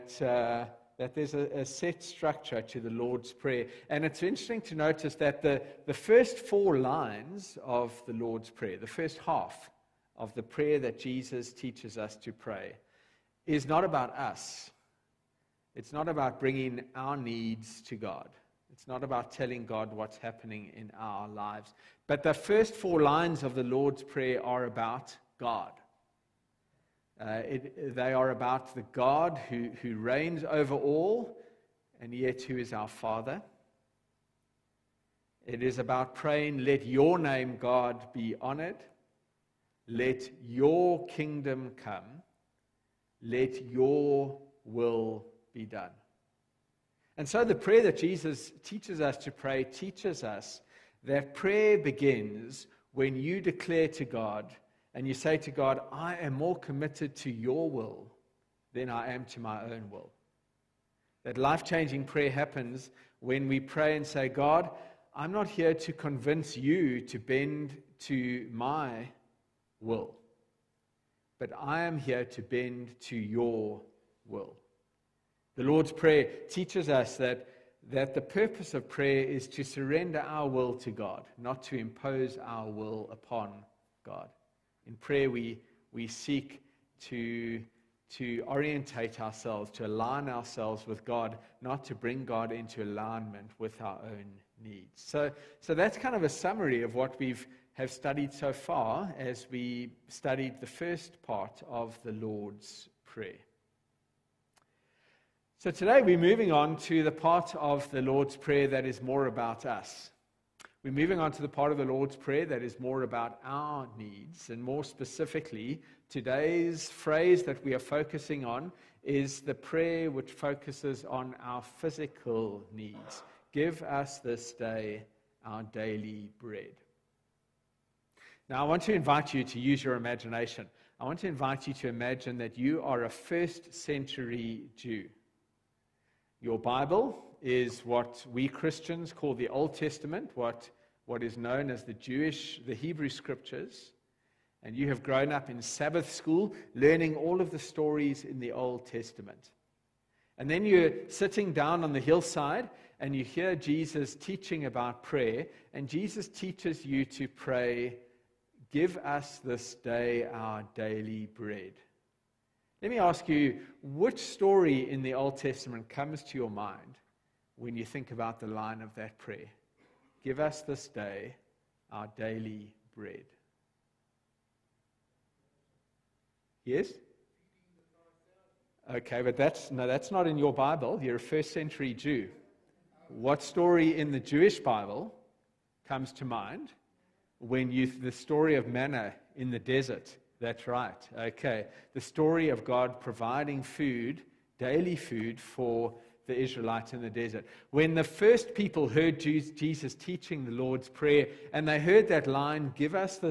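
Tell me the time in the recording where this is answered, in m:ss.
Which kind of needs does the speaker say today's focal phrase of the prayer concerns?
2:01.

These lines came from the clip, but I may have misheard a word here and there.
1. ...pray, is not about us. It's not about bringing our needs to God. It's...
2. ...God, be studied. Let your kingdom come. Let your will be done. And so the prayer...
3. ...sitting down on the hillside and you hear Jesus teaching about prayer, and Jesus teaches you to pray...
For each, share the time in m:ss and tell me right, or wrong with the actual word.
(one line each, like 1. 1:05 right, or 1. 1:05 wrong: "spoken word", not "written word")
1. 0:12 right
2. 0:37 wrong: "honored", not "studied"
3. 2:31 right.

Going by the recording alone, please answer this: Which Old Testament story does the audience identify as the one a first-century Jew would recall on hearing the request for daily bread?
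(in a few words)
Manna in the desert.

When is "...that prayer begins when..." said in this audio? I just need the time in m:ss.
0:51.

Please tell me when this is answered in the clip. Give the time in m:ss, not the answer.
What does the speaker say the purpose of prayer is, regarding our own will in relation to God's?
1:19.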